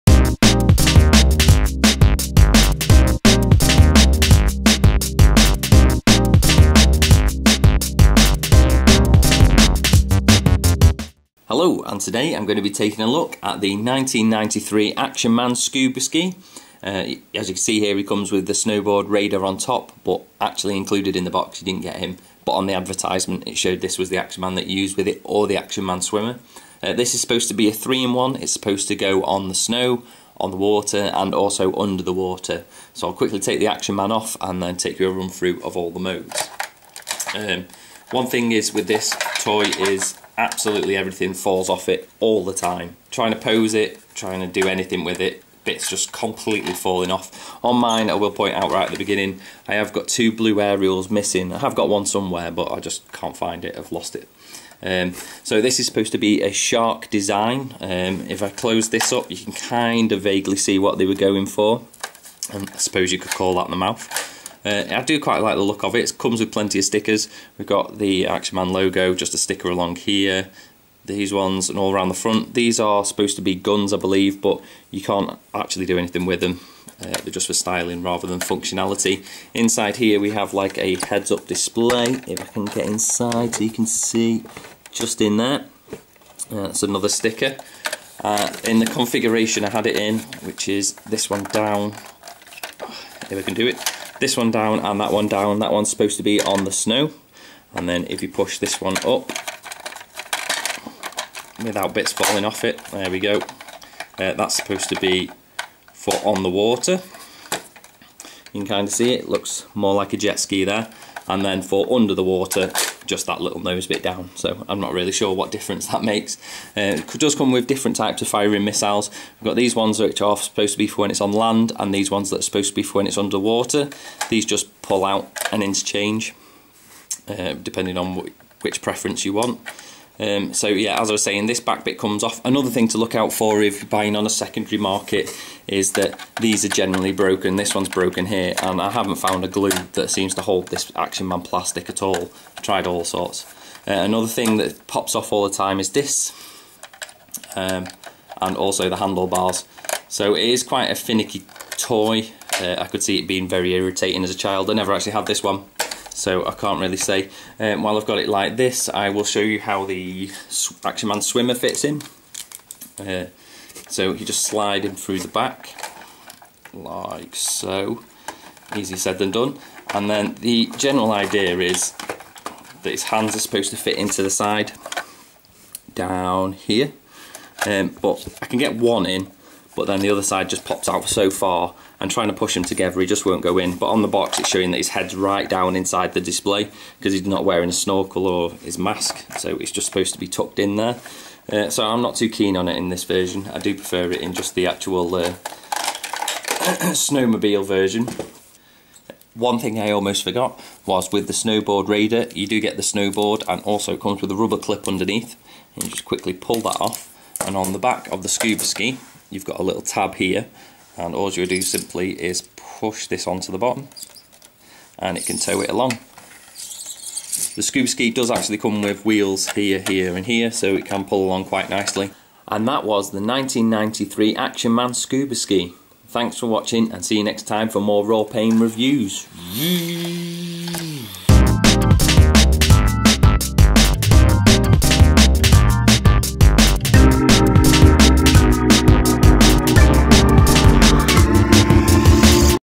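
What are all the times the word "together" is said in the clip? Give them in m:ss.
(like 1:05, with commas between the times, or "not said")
3:02.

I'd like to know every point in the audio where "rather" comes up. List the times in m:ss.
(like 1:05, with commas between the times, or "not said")
1:18.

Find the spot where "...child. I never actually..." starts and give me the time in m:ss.
2:34.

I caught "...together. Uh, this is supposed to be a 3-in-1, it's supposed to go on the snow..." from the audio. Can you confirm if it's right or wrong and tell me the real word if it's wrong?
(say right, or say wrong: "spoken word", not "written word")
wrong: "swimmer", not "together".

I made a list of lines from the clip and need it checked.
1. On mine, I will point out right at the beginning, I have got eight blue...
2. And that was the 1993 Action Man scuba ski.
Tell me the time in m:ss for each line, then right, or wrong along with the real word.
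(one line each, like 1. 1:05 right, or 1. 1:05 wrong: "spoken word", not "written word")
1. 0:47 wrong: "two", not "eight"
2. 3:42 right.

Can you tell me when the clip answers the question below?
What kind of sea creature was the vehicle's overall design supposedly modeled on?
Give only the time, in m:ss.
0:56.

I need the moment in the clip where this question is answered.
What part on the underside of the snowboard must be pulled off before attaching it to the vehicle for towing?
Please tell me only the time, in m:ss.
3:24.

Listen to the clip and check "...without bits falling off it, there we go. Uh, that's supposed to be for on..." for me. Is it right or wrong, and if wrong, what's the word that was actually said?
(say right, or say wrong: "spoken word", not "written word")
right.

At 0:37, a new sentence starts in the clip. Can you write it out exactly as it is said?
Um, one thing is with this toy is absolutely everything falls off it all the time.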